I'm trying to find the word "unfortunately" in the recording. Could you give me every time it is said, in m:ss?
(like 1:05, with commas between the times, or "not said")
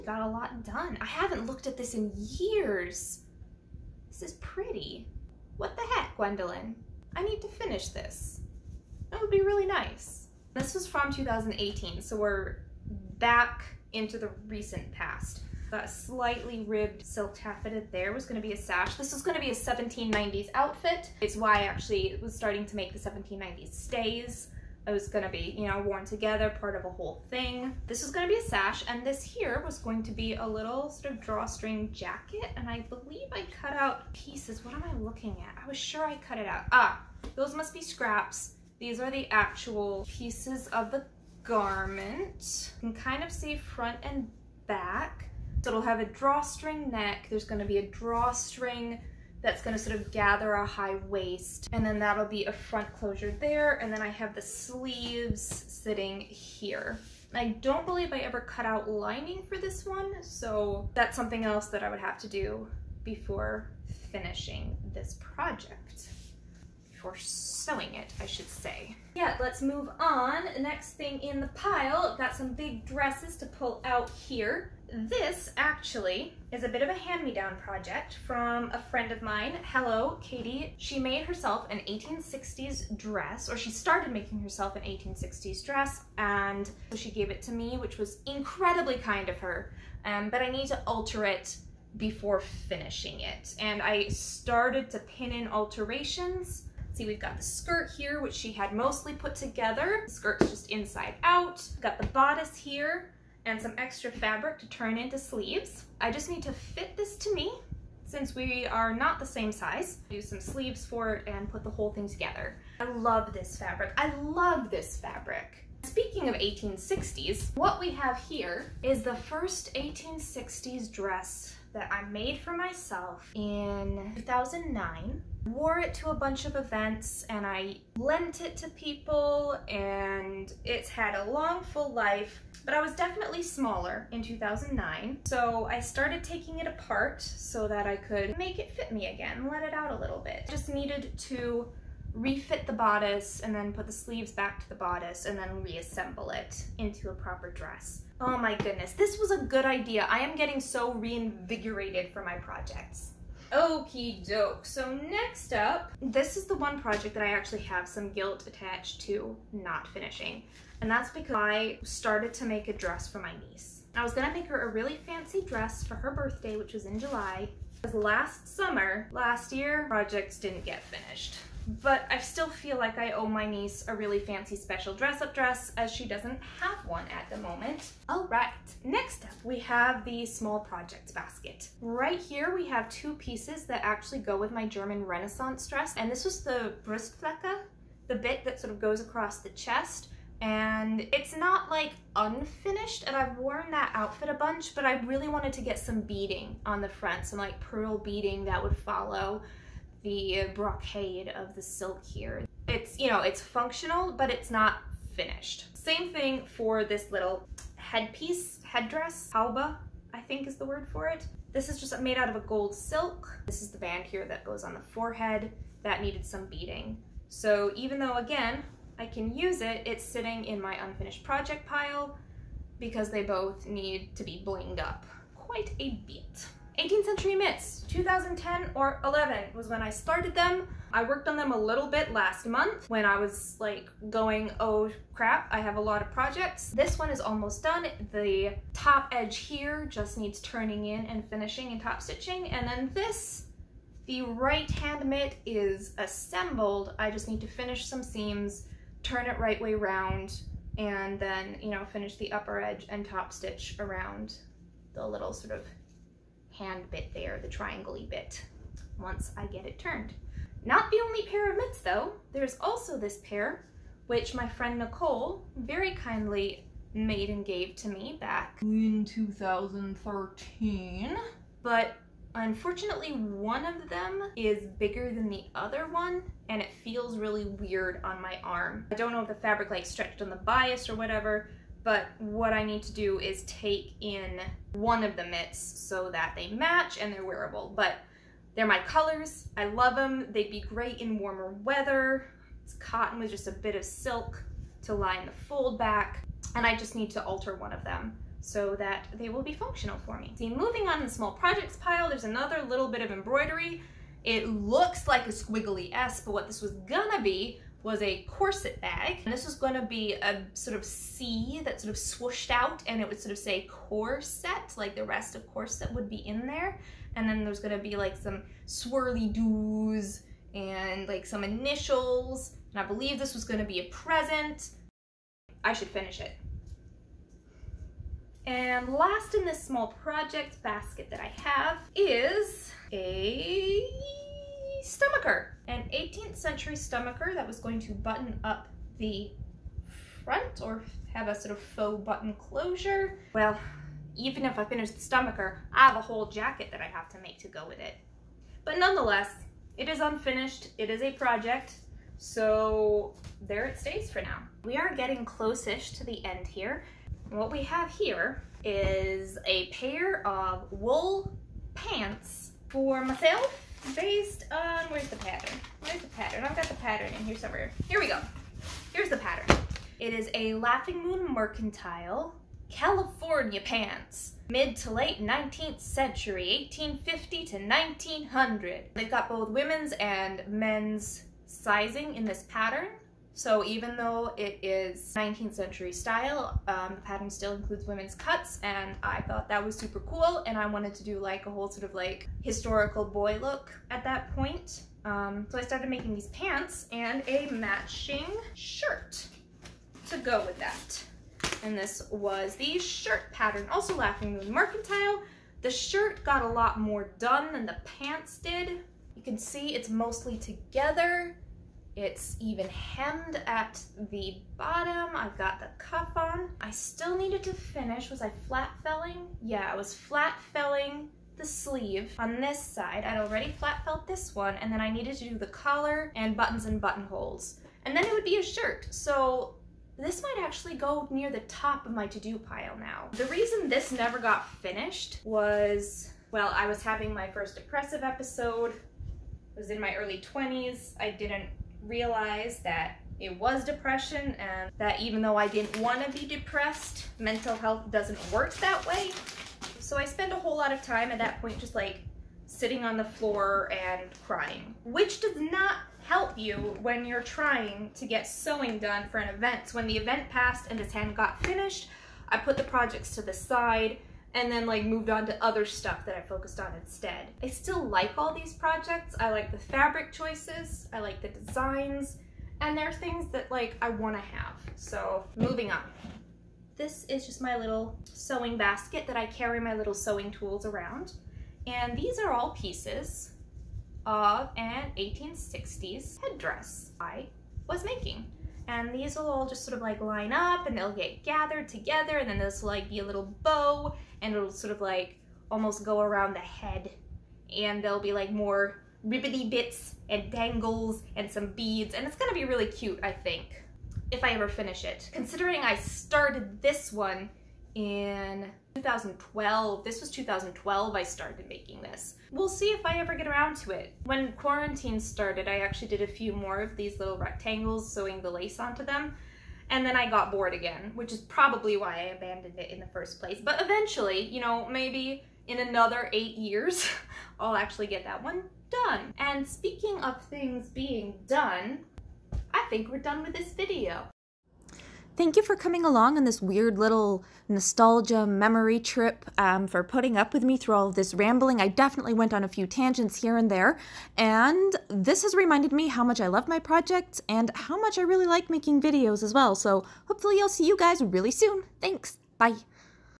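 4:32.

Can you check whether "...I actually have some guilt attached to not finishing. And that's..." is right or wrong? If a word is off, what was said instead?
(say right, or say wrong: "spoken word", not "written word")
right.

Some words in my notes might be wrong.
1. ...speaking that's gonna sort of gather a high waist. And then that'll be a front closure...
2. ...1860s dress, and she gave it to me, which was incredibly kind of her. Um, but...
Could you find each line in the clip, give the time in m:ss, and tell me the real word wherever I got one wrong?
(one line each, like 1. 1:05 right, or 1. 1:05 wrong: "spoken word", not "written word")
1. 0:47 wrong: "drawstring", not "speaking"
2. 1:24 right.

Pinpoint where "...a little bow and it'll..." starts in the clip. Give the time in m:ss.
8:12.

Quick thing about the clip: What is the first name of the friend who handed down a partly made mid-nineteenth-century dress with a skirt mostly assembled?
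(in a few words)
Katie.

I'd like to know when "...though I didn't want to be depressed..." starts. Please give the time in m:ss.
7:25.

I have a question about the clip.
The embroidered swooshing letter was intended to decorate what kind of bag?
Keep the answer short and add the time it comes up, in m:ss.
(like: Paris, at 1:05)
corset bag, at 5:08.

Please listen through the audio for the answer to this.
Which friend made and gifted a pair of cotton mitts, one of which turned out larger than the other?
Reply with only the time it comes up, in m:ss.
4:24.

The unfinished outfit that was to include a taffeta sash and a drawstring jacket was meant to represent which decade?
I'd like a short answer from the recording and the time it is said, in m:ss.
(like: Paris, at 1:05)
1790s, at 0:19.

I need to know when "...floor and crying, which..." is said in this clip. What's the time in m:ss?
7:33.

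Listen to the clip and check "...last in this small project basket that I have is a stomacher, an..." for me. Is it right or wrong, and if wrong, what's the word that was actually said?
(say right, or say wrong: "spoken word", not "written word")
right.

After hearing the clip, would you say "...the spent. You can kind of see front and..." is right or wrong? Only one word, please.
wrong.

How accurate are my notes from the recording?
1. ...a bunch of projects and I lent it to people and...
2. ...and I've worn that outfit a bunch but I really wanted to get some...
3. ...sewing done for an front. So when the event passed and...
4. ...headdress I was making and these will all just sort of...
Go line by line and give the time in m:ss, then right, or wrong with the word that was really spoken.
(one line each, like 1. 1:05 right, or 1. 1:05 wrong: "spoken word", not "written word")
1. 2:06 wrong: "events", not "projects"
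2. 3:13 right
3. 7:38 wrong: "event", not "front"
4. 8:06 right.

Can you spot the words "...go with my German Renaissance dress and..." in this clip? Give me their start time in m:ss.
3:04.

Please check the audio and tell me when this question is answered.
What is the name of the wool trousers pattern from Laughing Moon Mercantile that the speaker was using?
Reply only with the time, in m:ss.
6:12.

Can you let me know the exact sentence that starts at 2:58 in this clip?
All right, next up we have the small project basket.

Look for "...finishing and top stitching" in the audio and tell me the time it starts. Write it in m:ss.
4:01.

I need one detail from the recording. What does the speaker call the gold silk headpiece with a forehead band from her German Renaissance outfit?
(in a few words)
halba.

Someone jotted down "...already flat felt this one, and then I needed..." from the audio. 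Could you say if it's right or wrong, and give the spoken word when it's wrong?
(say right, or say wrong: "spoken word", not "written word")
right.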